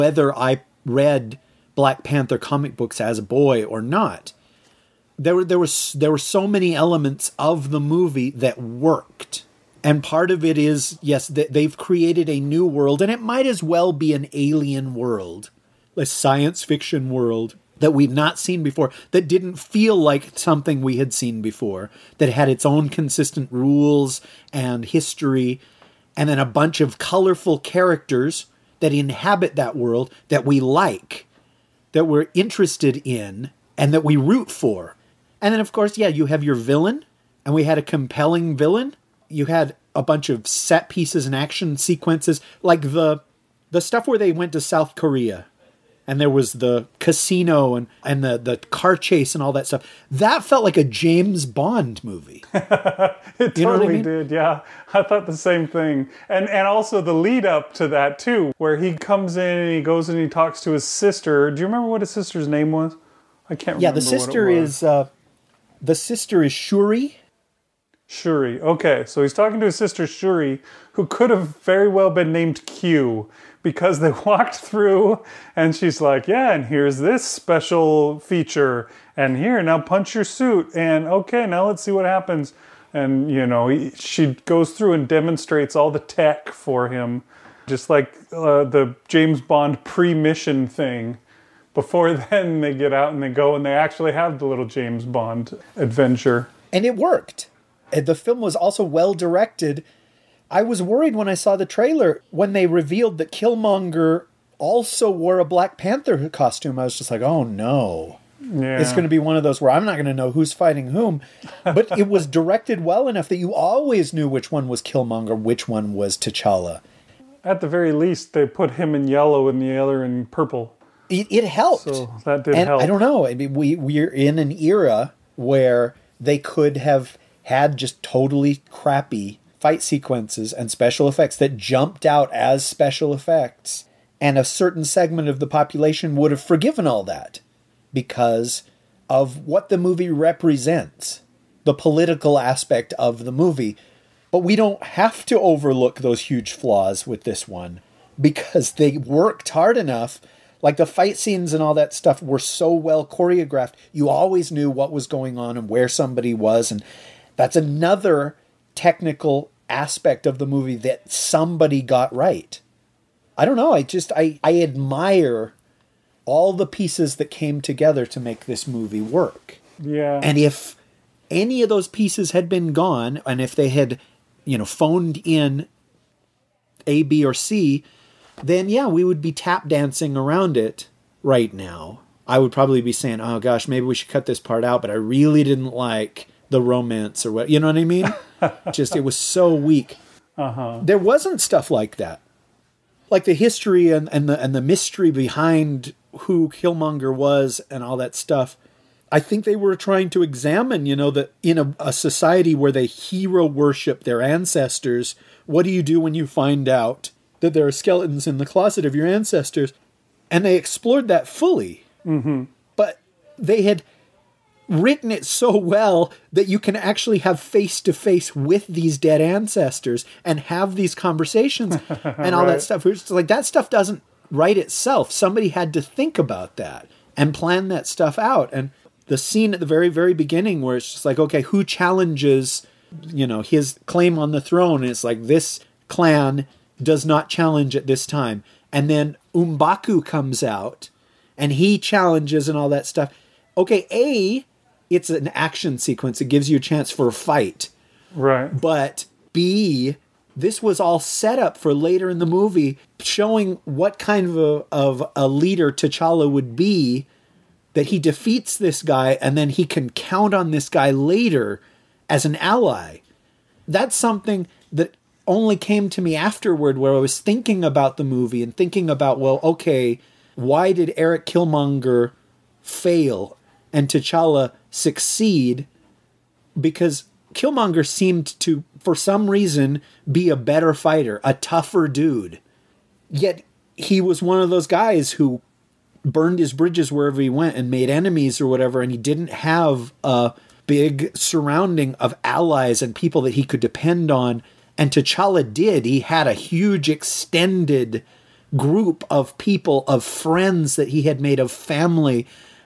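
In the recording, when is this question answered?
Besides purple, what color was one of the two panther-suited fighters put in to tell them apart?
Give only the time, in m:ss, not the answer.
1:59.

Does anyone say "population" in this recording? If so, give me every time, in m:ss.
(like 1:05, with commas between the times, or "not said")
2:15.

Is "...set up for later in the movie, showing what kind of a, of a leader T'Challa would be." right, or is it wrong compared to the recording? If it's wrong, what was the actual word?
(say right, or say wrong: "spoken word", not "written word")
right.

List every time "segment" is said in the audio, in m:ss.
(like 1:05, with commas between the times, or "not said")
2:14.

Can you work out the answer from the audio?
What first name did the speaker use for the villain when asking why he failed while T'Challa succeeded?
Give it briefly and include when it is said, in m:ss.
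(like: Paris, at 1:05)
Eric, at 4:30.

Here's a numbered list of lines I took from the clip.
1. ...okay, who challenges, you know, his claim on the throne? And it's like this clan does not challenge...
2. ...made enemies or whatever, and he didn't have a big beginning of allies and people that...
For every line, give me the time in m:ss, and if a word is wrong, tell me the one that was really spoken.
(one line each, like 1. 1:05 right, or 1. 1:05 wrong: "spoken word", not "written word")
1. 3:51 right
2. 4:47 wrong: "surrounding", not "beginning".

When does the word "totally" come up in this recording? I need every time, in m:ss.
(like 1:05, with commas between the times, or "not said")
0:53, 2:08.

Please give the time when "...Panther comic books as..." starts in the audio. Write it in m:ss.
0:02.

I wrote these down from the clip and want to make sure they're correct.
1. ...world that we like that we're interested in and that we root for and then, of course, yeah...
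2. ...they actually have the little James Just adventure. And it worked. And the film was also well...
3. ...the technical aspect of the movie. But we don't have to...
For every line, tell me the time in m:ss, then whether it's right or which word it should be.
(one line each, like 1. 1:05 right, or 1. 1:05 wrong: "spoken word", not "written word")
1. 0:29 right
2. 1:33 wrong: "Bond", not "Just"
3. 2:21 wrong: "political", not "technical".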